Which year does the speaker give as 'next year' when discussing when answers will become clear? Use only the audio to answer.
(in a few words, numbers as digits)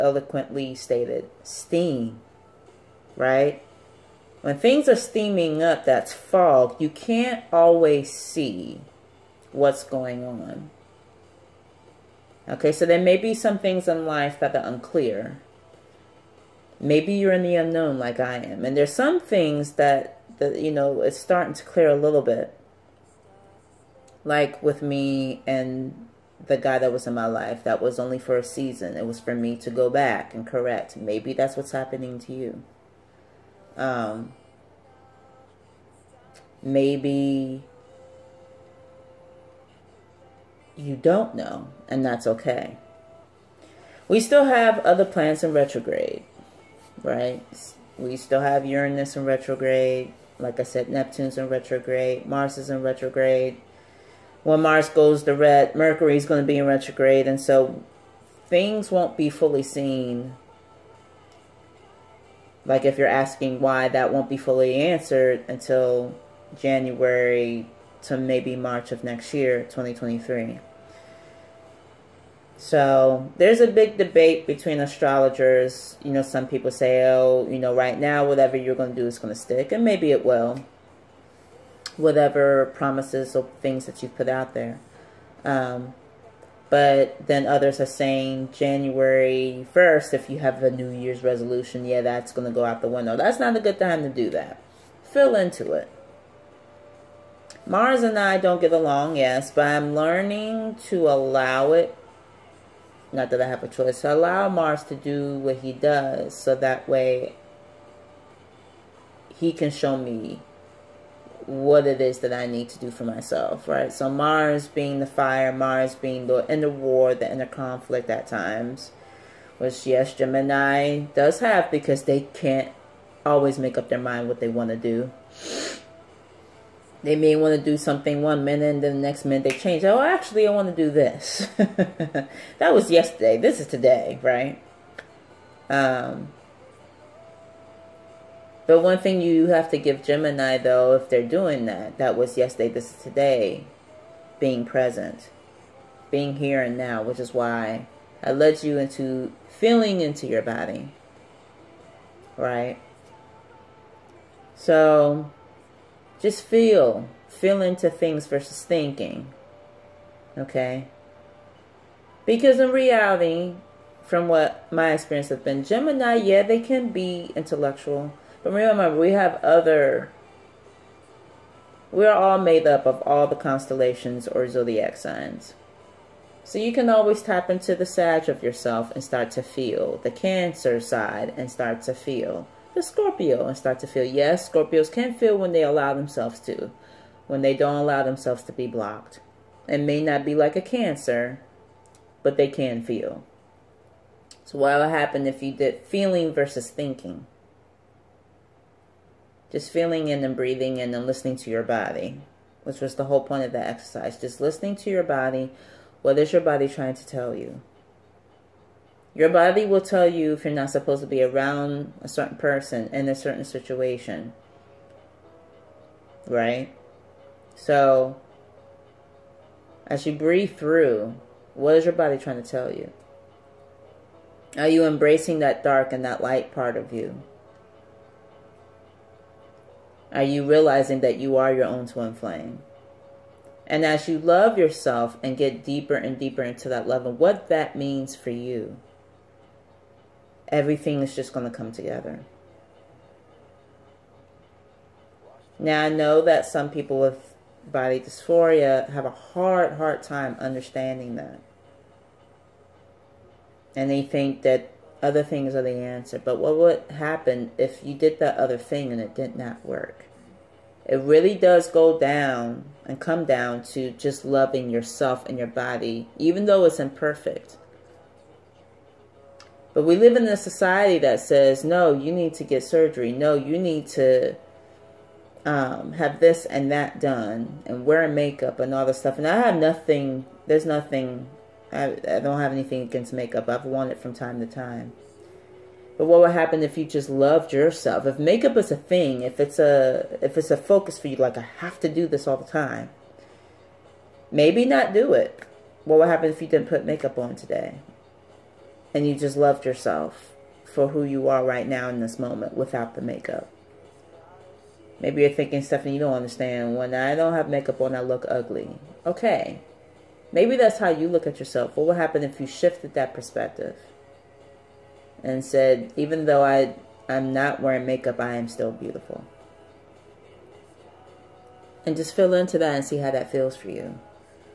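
2023.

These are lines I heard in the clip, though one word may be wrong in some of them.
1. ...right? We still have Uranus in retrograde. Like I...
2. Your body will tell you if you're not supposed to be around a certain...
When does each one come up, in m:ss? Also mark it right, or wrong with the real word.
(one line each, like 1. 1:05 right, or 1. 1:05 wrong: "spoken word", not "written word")
1. 0:47 right
2. 3:29 right.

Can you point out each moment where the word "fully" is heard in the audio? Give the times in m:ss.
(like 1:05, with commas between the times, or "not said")
0:59, 1:04.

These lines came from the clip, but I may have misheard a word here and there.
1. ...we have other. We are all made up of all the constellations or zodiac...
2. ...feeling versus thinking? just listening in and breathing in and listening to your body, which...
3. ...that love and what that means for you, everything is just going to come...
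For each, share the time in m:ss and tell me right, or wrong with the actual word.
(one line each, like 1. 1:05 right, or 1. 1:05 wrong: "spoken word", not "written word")
1. 2:48 right
2. 3:15 wrong: "feeling", not "listening"
3. 3:56 right.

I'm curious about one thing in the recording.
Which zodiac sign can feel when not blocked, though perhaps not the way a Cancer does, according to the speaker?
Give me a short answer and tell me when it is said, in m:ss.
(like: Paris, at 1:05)
Scorpio, at 3:04.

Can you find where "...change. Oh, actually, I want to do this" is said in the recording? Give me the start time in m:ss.
2:09.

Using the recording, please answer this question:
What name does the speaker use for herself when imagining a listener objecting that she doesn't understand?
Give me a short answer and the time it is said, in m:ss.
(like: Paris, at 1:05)
Stephanie, at 5:05.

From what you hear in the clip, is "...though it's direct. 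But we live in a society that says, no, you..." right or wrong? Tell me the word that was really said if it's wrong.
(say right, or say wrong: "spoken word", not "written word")
wrong: "imperfect", not "direct".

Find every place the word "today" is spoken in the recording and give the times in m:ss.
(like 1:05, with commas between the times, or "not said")
2:13, 2:23, 4:57.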